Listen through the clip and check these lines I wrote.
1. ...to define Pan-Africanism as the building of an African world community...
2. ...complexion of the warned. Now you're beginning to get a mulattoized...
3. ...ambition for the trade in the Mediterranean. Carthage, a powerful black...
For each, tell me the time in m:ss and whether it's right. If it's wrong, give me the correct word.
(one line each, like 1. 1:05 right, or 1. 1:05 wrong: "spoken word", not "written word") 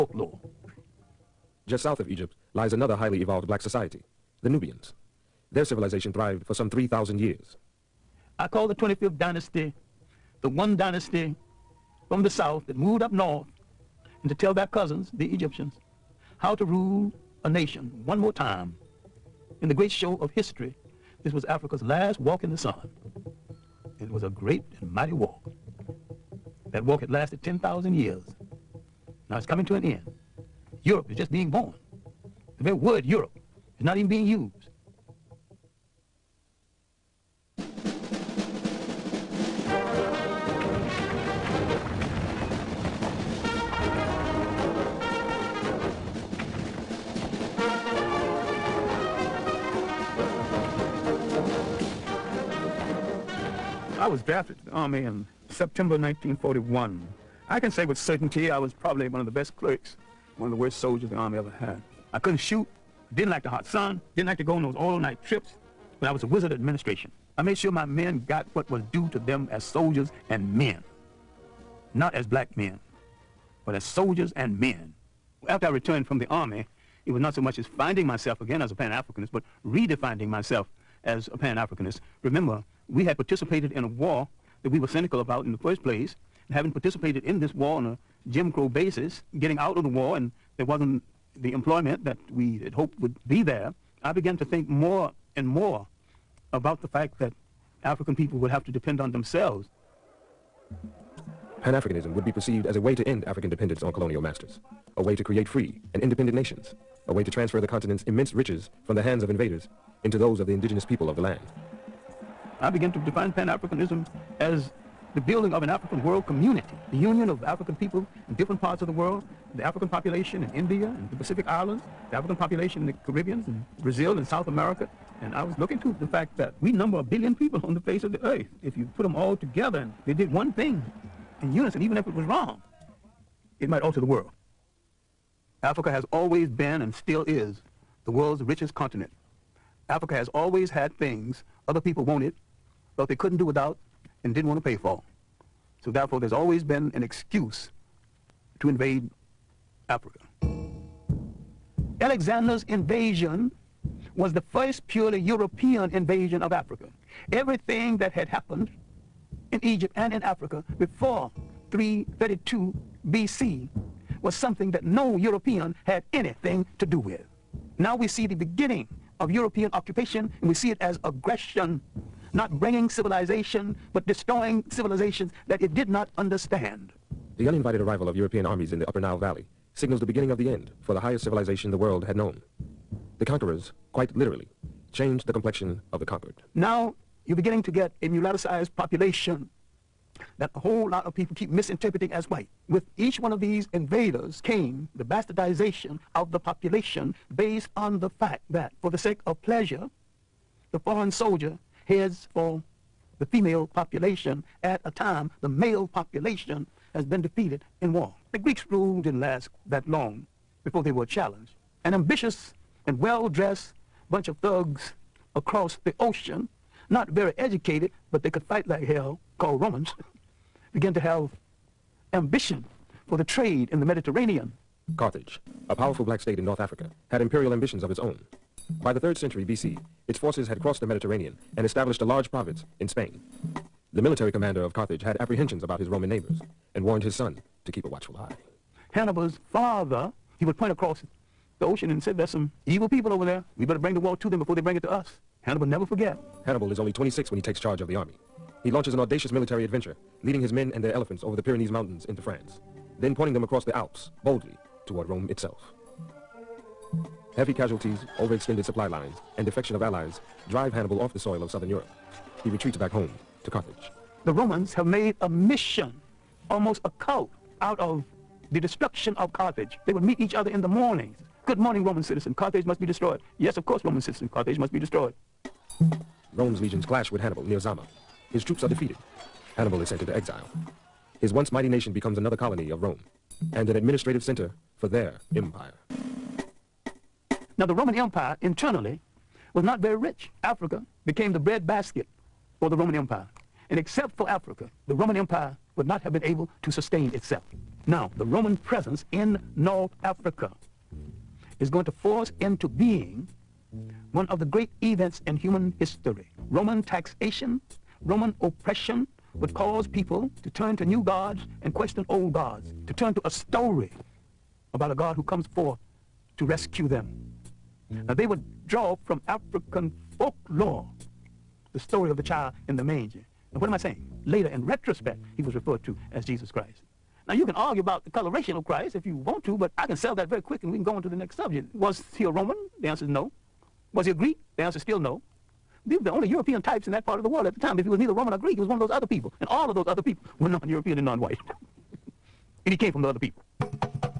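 1. 1:52 right
2. 3:05 wrong: "conquered", not "warned"
3. 3:42 right.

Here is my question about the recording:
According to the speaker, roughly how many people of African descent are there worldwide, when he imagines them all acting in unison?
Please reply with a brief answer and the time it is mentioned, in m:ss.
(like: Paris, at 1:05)
a billion, at 2:06.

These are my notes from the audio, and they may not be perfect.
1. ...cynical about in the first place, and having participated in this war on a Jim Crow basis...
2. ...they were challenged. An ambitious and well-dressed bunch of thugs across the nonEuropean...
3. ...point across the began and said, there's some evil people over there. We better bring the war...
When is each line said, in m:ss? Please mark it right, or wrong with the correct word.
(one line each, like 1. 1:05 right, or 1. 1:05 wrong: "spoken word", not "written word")
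1. 1:24 right
2. 3:30 wrong: "ocean", not "nonEuropean"
3. 4:00 wrong: "ocean", not "began".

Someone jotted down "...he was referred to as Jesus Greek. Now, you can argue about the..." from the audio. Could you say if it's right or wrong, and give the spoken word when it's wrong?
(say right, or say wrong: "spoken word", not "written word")
wrong: "Christ", not "Greek".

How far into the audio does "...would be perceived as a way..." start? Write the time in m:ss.
1:42.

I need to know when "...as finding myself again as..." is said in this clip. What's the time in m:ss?
1:17.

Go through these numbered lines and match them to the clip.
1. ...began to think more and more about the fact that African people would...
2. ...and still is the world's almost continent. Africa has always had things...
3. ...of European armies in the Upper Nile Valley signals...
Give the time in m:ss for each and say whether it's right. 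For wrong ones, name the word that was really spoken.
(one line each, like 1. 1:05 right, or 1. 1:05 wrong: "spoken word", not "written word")
1. 1:34 right
2. 2:16 wrong: "richest", not "almost"
3. 2:58 right.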